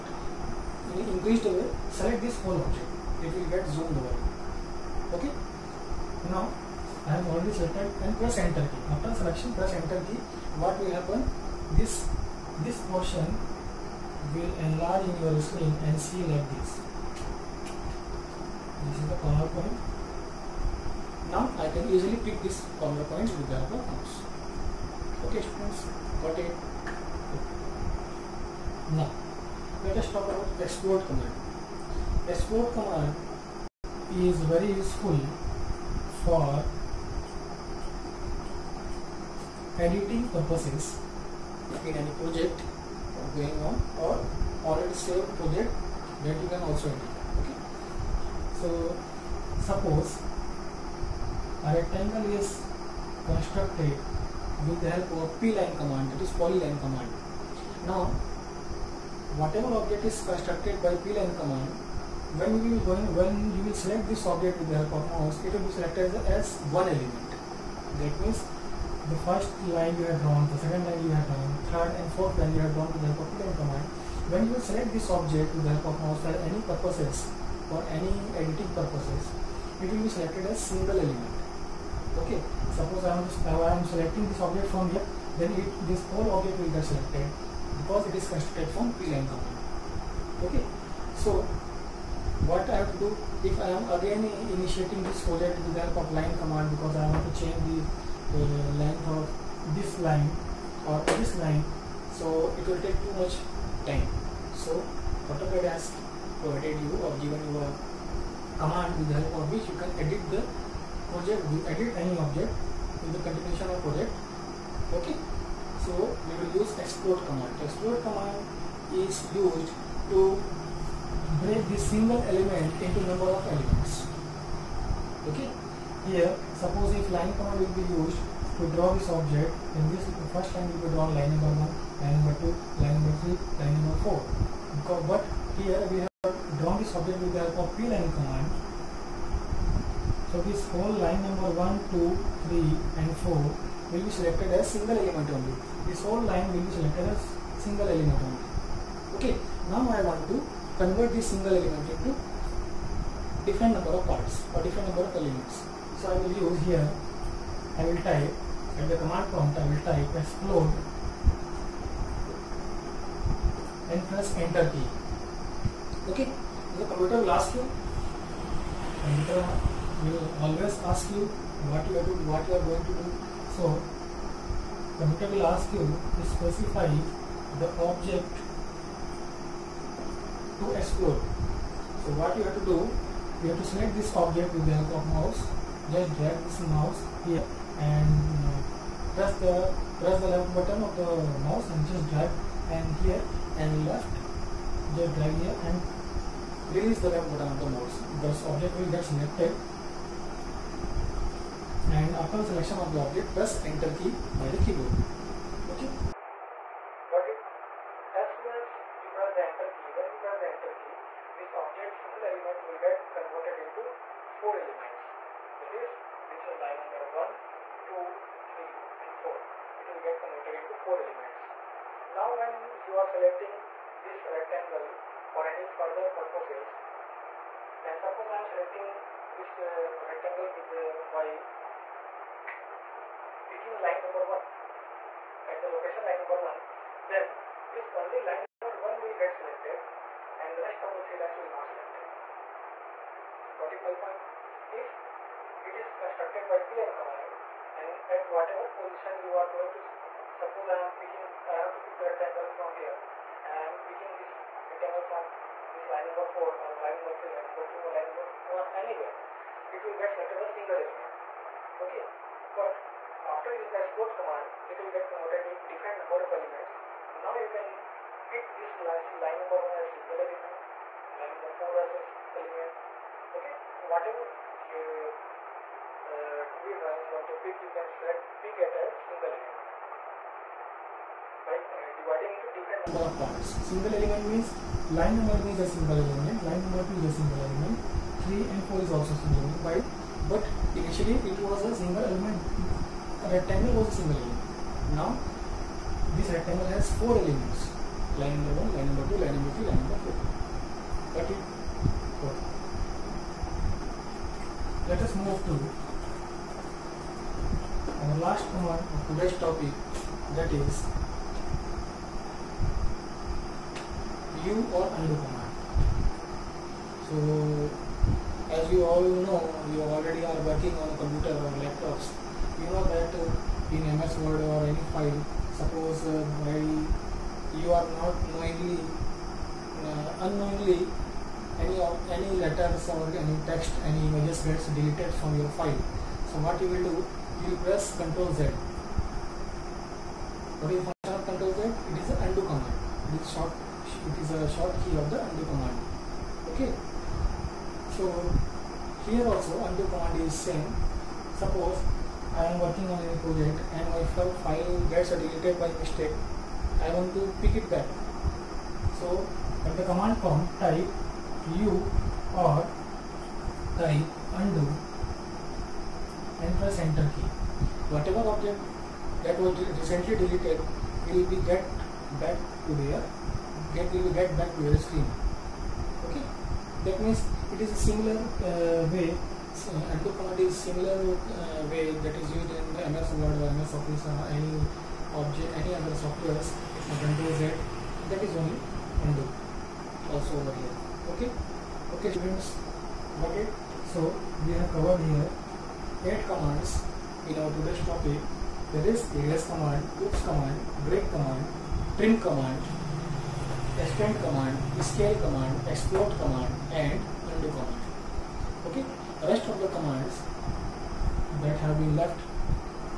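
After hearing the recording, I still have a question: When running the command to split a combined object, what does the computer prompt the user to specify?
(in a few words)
The object to explode.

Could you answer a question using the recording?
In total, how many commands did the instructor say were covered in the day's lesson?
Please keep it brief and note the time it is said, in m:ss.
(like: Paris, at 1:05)
8, at 6:36.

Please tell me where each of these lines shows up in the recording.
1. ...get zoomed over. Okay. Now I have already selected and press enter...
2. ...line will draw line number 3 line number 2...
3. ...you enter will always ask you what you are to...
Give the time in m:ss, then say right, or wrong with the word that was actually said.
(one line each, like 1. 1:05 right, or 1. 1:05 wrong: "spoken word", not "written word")
1. 0:03 right
2. 2:10 wrong: "1", not "3"
3. 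2:47 right.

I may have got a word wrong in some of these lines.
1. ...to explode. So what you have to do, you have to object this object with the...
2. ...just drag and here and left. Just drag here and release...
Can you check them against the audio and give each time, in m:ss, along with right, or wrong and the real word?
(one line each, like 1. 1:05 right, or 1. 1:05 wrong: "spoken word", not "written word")
1. 3:00 wrong: "select", not "object"
2. 3:11 right.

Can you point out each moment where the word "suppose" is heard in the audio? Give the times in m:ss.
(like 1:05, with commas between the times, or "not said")
0:49, 1:22, 2:06, 3:47, 4:10, 5:25, 5:51.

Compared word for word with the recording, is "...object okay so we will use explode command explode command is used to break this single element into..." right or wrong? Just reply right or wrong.
wrong.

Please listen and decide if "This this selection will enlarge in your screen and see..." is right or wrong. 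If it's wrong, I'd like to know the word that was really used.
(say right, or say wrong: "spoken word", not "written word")
wrong: "portion", not "selection".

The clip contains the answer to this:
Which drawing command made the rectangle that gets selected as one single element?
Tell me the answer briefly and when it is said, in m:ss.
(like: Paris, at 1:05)
Polyline, at 0:56.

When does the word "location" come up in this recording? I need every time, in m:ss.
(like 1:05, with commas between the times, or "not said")
3:55.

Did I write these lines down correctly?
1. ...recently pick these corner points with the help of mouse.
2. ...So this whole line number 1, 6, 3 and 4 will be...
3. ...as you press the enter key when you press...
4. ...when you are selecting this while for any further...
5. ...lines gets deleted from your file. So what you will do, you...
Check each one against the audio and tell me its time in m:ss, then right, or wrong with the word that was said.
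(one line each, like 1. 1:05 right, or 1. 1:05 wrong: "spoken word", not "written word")
1. 0:21 wrong: "easily", not "recently"
2. 2:20 wrong: "2", not "6"
3. 3:28 right
4. 3:42 wrong: "rectangle", not "while"
5. 5:34 wrong: "images", not "lines".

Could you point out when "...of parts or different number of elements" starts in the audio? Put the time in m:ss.
2:33.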